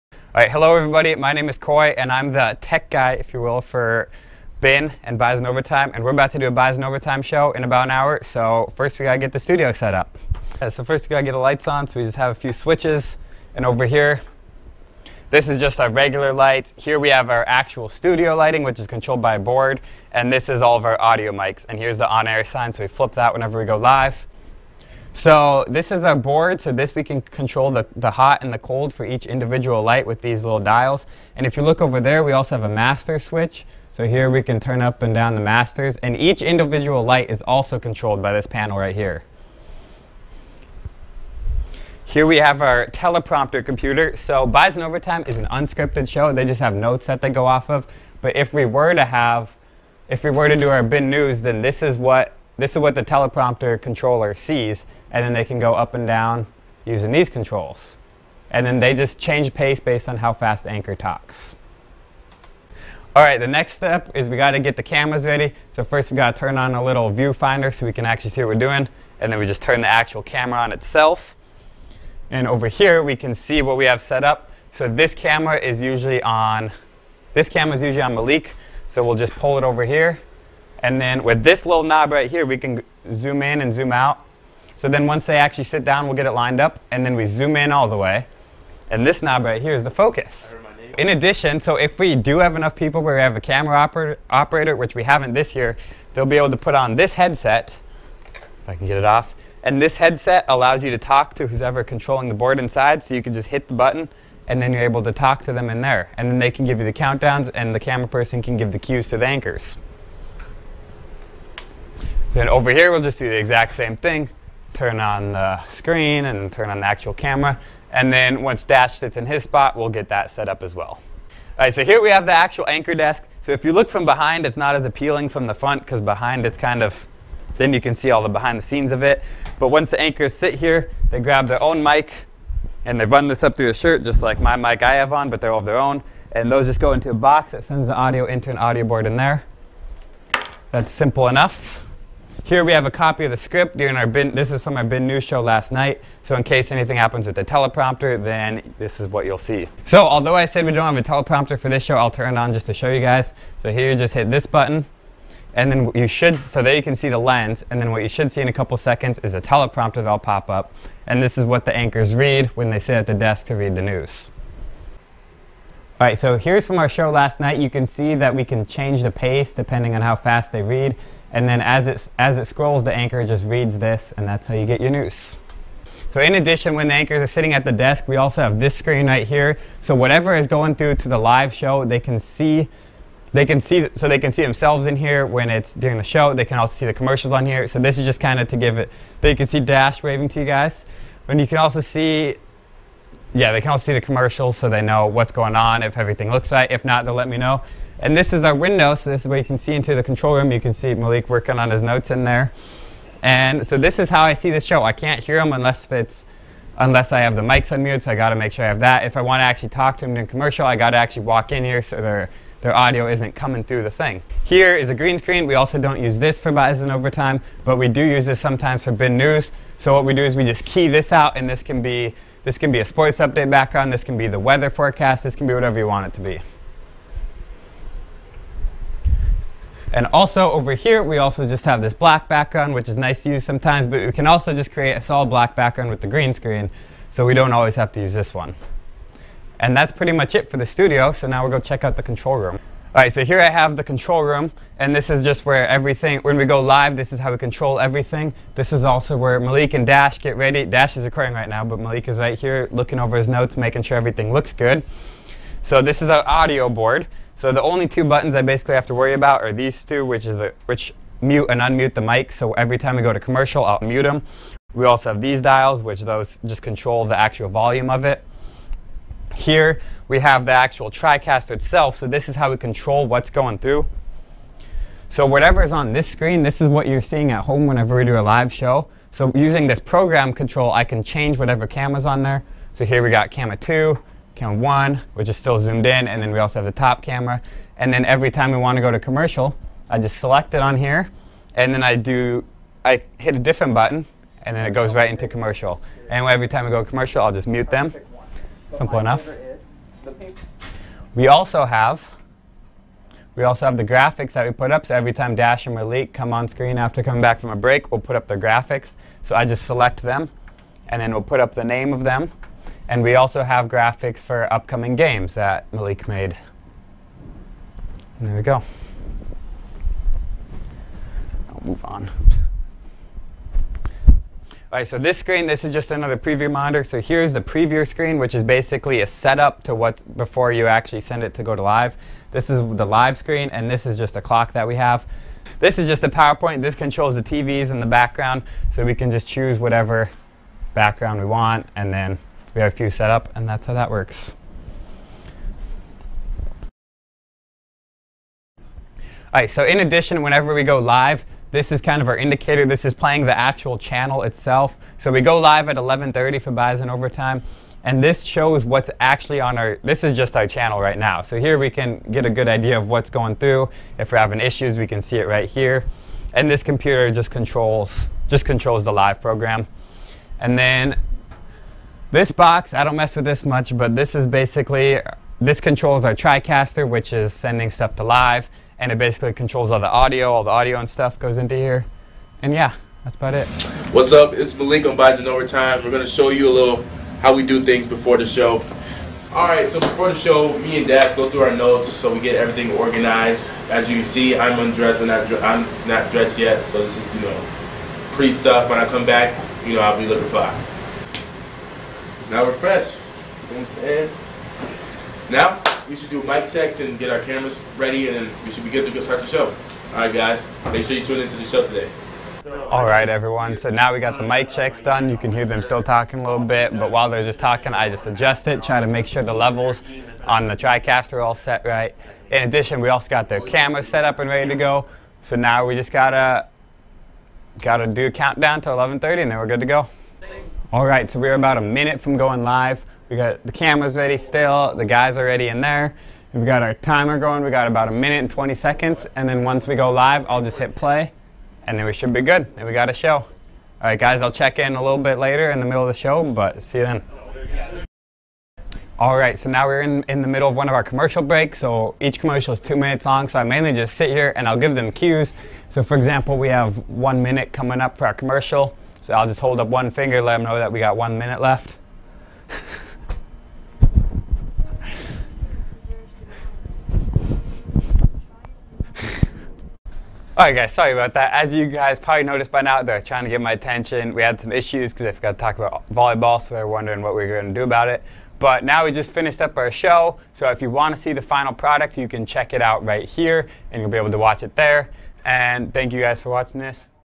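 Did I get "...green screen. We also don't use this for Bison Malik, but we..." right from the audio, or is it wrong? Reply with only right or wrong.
wrong.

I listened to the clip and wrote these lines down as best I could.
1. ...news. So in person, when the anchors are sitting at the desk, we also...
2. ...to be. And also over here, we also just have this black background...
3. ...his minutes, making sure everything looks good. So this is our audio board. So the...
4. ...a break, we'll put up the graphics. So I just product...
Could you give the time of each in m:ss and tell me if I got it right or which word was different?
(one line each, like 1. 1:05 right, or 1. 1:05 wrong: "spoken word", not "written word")
1. 2:54 wrong: "addition", not "person"
2. 3:46 right
3. 4:13 wrong: "notes", not "minutes"
4. 5:07 wrong: "select", not "product".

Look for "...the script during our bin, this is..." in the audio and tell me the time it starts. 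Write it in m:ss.
2:23.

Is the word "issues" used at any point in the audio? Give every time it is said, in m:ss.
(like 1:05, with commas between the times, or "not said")
6:04, 7:54.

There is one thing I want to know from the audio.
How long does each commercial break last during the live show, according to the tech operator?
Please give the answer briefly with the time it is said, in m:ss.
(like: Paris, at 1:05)
2 minutes, at 7:32.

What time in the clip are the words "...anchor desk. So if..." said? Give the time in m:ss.
2:02.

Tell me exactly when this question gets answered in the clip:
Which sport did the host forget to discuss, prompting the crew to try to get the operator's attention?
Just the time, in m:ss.
7:55.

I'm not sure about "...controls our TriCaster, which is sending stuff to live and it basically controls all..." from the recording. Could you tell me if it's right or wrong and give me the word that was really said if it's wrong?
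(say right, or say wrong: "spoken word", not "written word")
right.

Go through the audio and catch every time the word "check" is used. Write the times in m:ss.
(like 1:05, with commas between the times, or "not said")
4:01, 6:46, 6:54, 7:24, 8:02.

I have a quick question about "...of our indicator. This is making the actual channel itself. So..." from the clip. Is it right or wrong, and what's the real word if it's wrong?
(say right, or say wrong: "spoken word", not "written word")
wrong: "playing", not "making".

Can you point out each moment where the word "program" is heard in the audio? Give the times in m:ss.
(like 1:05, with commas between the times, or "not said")
4:39, 6:09.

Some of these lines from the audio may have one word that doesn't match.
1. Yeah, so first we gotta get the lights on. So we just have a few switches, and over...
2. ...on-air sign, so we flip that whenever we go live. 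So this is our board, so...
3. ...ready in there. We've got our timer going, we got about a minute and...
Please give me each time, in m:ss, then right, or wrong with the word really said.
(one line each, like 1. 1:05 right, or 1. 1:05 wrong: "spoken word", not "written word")
1. 0:10 right
2. 0:22 right
3. 7:15 right.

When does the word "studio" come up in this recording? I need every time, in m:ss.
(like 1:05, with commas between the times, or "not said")
0:09, 0:17, 4:00.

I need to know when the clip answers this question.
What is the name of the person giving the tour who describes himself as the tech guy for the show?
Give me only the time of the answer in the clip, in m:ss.
0:01.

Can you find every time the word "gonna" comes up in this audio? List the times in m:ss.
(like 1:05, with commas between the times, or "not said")
6:25.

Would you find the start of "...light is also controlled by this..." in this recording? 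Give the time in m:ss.
0:37.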